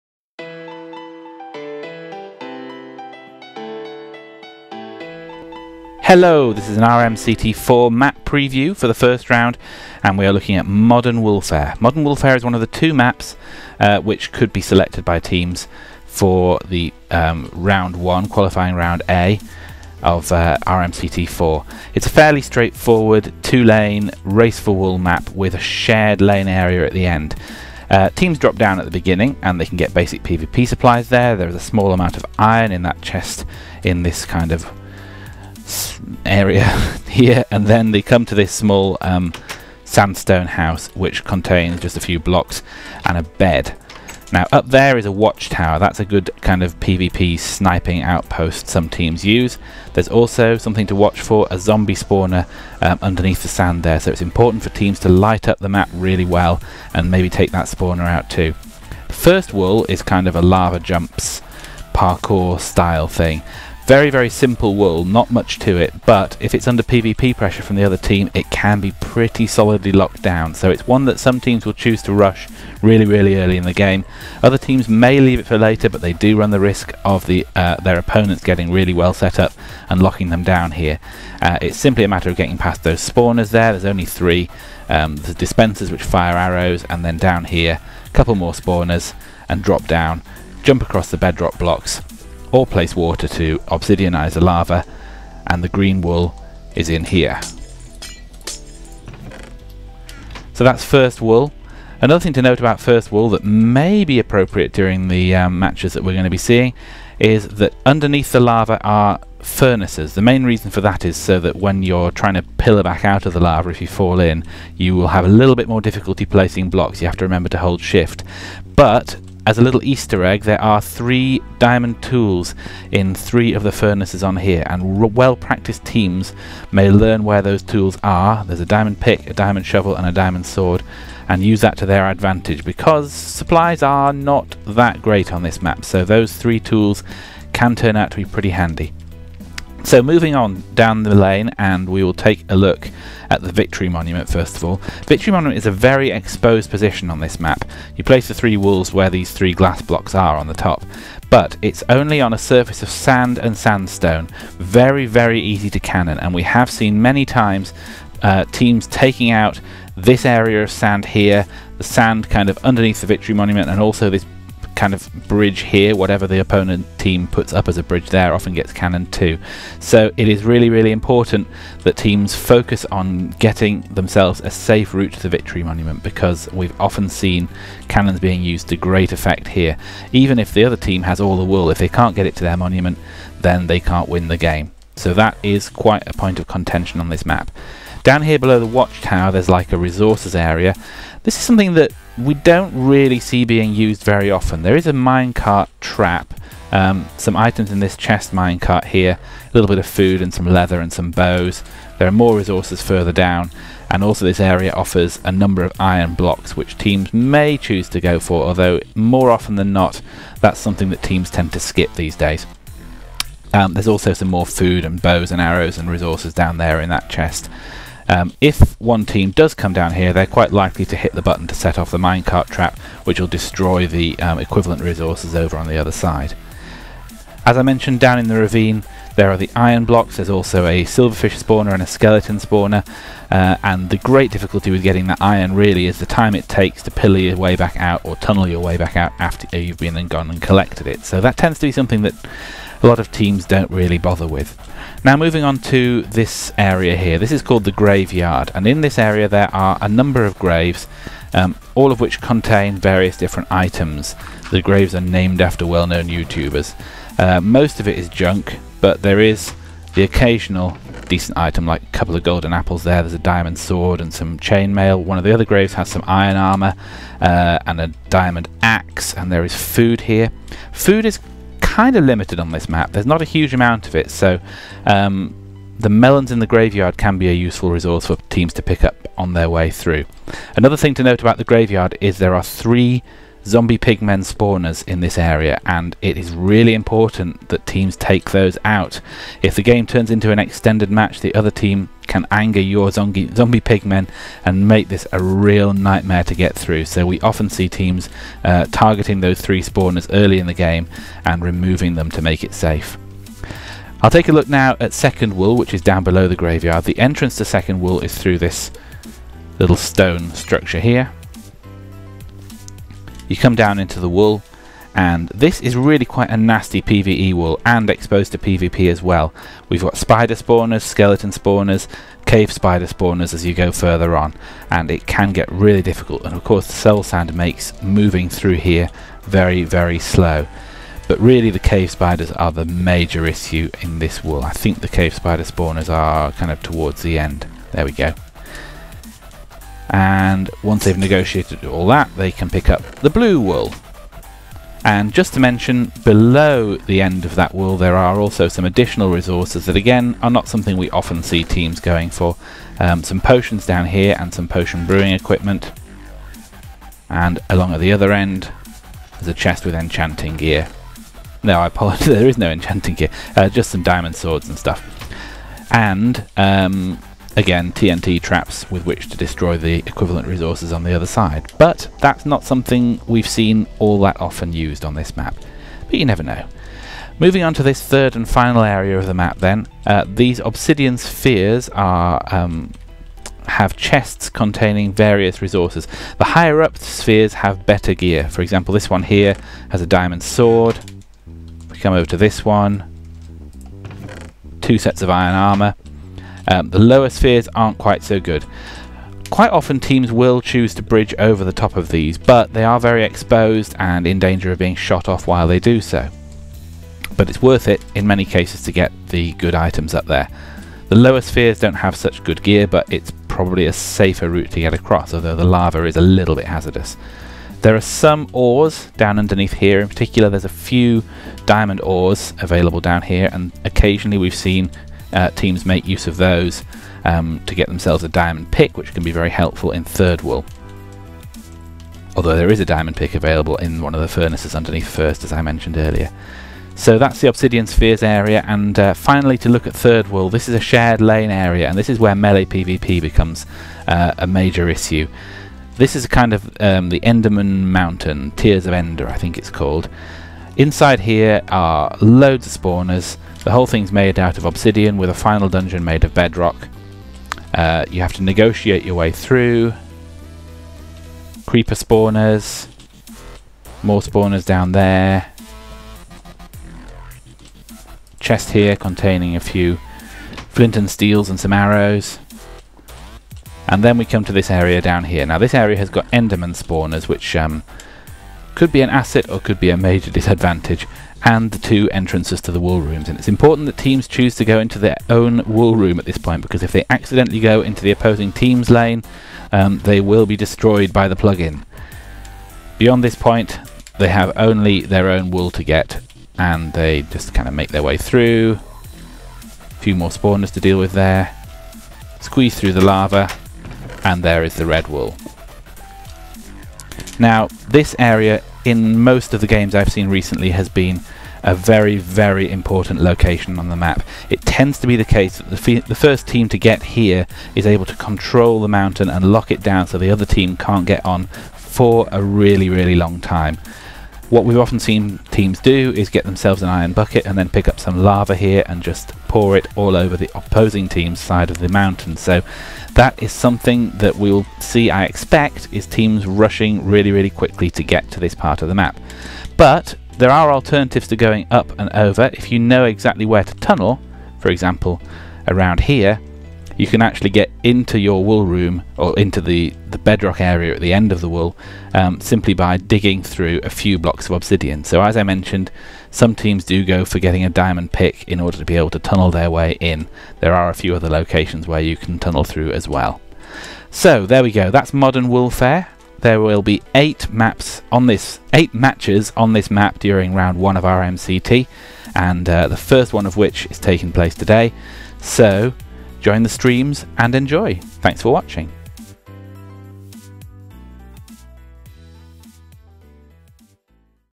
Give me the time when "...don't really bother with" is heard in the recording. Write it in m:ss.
4:03.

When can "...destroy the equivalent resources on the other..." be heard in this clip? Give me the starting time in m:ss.
6:09.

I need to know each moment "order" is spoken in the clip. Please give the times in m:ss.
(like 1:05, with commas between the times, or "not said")
9:18.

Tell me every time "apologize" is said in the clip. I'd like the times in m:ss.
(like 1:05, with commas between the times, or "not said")
6:01.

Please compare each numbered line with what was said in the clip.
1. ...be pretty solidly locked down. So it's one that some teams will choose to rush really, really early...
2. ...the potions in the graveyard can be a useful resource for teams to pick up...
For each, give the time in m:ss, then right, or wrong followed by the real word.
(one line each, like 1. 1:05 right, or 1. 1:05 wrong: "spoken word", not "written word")
1. 1:08 right
2. 4:35 wrong: "melons", not "potions".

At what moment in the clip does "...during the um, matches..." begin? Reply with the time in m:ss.
1:44.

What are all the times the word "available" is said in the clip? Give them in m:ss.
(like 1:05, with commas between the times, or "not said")
7:02, 7:13.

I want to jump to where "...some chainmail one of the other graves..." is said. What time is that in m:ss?
4:24.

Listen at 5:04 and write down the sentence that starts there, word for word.
I'll take a look now at Second Wool which is down below the graveyard.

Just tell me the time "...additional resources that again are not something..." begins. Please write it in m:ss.
5:48.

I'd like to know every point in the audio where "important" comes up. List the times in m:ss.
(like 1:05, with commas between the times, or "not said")
0:54, 2:50, 4:46, 8:03, 8:32.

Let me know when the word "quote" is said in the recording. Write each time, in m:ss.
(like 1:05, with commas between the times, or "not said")
not said.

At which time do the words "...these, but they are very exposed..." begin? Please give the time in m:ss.
6:41.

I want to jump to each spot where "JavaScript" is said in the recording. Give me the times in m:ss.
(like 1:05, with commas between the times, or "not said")
not said.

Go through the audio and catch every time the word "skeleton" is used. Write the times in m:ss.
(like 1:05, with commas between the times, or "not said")
3:51, 5:20.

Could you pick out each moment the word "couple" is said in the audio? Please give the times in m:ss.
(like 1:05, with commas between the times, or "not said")
1:28, 4:21.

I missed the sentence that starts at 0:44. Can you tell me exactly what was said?
Now up there is a watchtower, that's a good kind of PvP sniping outpost some teams use.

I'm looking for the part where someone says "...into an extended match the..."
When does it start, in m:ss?
4:50.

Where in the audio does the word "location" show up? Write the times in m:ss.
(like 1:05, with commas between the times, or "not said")
8:32, 9:21.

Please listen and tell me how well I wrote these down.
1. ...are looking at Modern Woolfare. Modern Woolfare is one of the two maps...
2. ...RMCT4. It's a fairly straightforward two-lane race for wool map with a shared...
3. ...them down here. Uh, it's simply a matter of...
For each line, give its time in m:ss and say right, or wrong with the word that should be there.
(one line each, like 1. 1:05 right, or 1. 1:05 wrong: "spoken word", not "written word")
1. 0:10 right
2. 0:20 right
3. 1:20 right.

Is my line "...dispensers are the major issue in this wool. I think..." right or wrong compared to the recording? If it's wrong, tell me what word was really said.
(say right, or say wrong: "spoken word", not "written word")
wrong: "spiders", not "dispensers".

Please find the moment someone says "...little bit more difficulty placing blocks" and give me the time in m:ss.
1:55.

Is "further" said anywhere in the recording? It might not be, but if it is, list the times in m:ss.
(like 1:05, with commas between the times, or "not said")
3:22, 5:23.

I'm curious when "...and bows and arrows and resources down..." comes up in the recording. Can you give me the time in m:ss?
3:34.